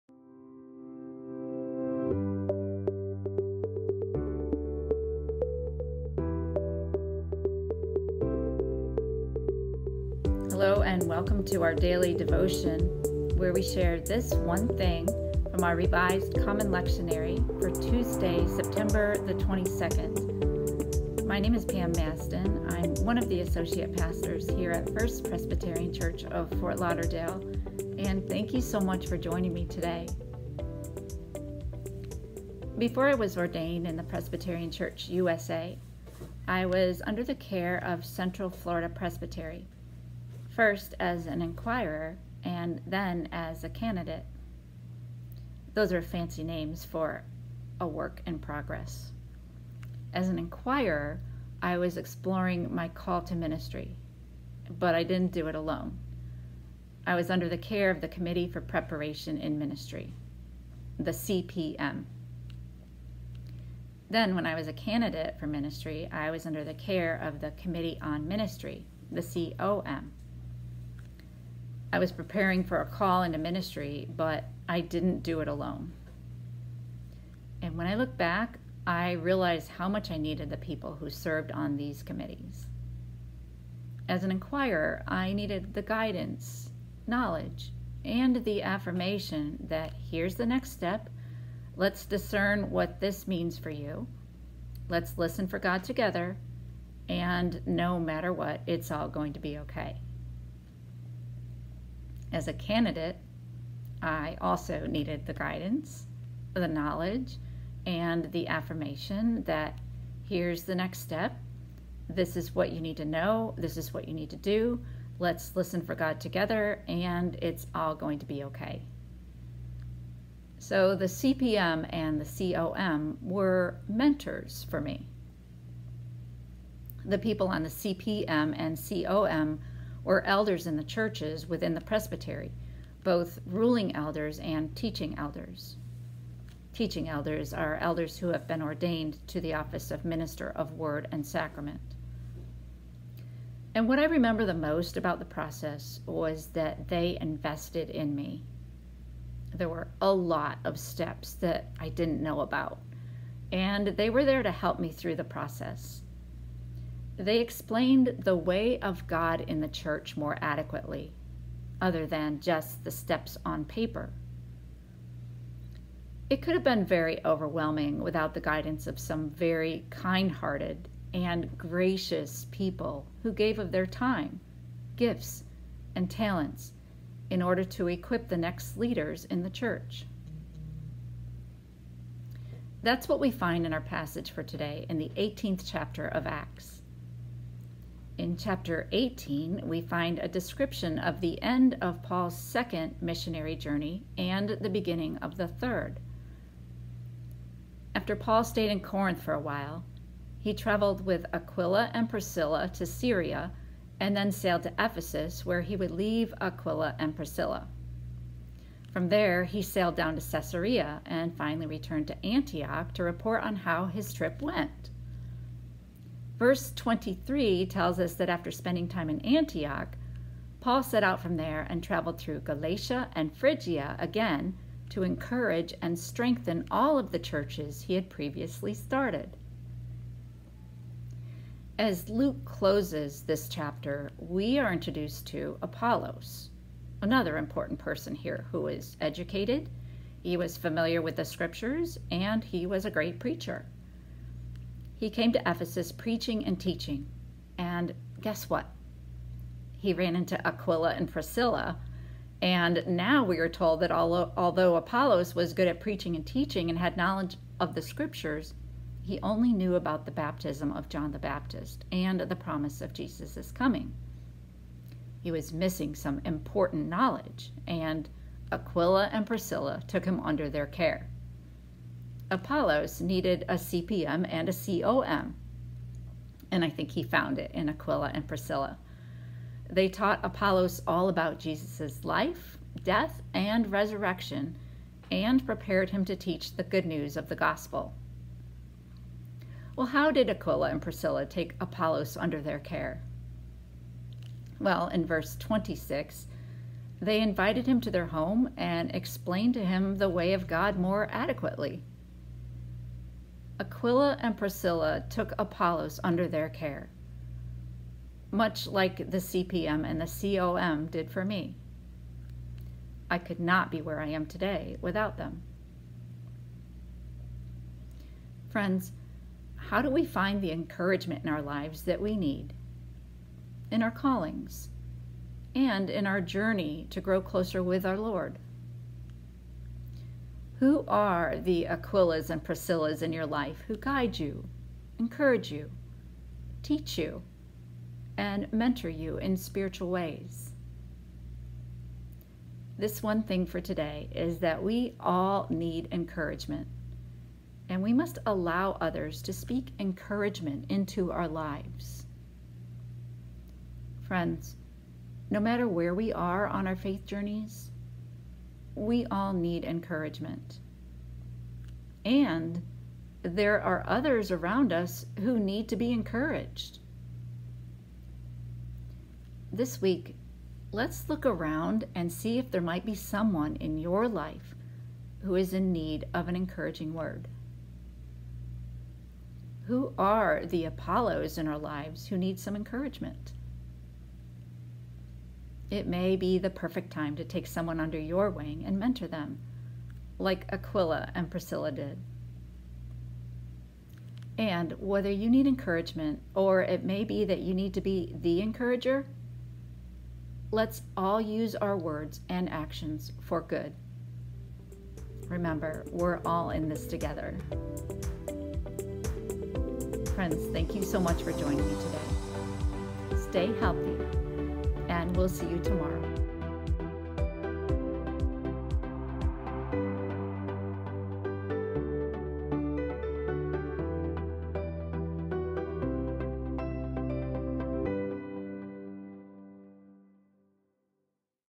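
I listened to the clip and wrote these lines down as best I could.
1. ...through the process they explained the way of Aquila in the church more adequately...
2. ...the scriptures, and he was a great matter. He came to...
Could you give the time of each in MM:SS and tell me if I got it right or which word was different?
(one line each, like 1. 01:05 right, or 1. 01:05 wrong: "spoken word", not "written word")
1. 02:34 wrong: "God", not "Aquila"
2. 04:01 wrong: "preacher", not "matter".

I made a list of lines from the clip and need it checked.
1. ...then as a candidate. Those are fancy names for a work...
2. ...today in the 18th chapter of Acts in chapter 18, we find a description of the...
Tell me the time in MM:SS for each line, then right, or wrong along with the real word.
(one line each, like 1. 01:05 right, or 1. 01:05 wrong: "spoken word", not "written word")
1. 00:42 right
2. 03:04 right.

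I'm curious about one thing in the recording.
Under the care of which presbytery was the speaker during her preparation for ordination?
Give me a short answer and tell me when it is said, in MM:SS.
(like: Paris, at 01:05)
Central Florida Presbytery, at 00:38.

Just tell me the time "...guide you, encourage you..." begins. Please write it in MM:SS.
05:33.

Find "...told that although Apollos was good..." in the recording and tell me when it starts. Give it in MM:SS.
04:13.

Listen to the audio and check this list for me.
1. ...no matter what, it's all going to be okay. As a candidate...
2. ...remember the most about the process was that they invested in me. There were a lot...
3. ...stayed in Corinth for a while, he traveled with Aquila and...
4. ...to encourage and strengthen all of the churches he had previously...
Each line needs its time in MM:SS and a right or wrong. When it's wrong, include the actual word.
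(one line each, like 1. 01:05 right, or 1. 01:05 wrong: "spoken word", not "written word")
1. 01:37 right
2. 02:24 right
3. 03:18 right
4. 03:44 right.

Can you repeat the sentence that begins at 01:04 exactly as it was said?
Then, when I was a candidate for ministry, I was under the care of the Committee on Ministry, the COM.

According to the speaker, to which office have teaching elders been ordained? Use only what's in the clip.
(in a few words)
minister of word and sacrament.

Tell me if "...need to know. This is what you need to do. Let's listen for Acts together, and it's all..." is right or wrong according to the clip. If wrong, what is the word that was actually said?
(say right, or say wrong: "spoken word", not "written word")
wrong: "God", not "Acts".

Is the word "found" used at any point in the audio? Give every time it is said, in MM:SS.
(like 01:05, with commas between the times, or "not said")
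04:37.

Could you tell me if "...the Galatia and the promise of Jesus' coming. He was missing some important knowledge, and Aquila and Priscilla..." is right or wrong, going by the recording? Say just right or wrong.
wrong.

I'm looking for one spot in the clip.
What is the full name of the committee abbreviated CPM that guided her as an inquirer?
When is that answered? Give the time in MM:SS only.
00:58.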